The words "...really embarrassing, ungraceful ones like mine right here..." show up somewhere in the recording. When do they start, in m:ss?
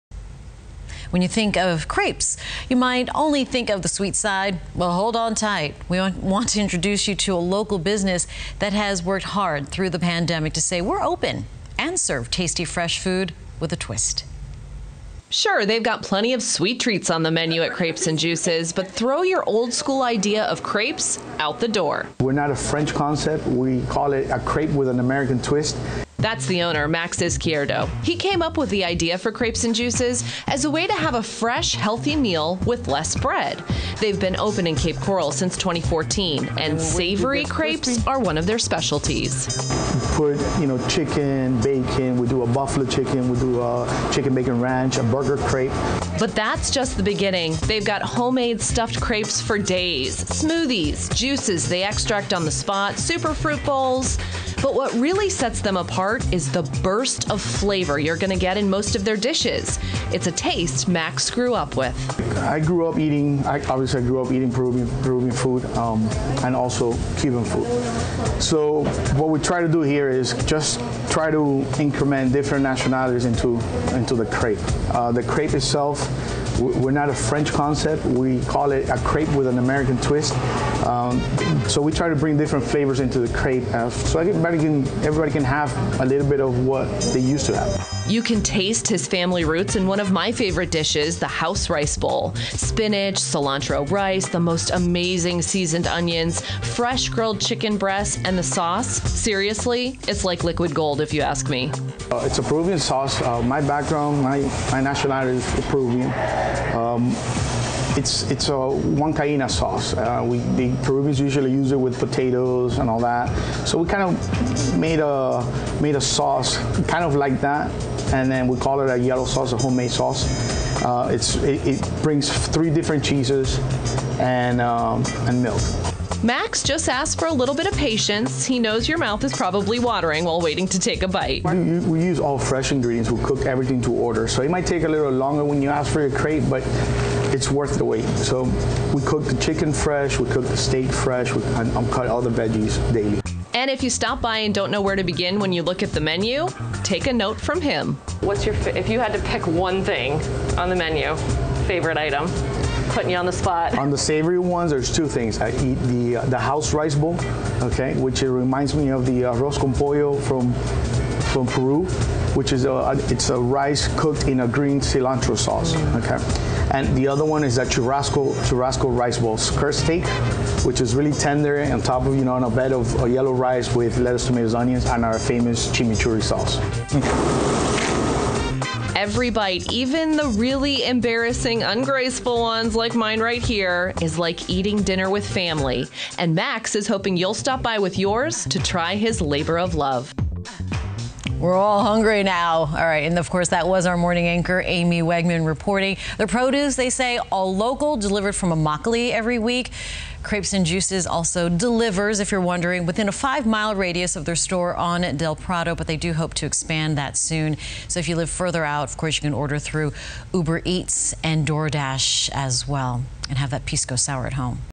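3:00.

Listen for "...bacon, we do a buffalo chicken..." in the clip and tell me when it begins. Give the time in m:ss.
0:41.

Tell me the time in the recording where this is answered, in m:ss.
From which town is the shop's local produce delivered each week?
3:18.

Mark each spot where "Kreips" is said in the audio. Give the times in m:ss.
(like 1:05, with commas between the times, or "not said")
0:17, 0:29, 3:20.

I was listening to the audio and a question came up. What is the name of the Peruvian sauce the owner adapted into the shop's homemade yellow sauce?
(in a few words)
Huancaina.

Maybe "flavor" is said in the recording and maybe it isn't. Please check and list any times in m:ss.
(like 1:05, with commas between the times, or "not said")
0:57, 1:22.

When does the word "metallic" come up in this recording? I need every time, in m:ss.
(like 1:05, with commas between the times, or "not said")
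not said.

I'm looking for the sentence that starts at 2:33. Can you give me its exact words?
On the savory ones, there's two things.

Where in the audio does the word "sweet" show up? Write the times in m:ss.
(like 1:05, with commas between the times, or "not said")
0:03, 0:16.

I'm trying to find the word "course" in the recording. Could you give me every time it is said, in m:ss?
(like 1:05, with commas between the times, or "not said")
3:13, 3:28.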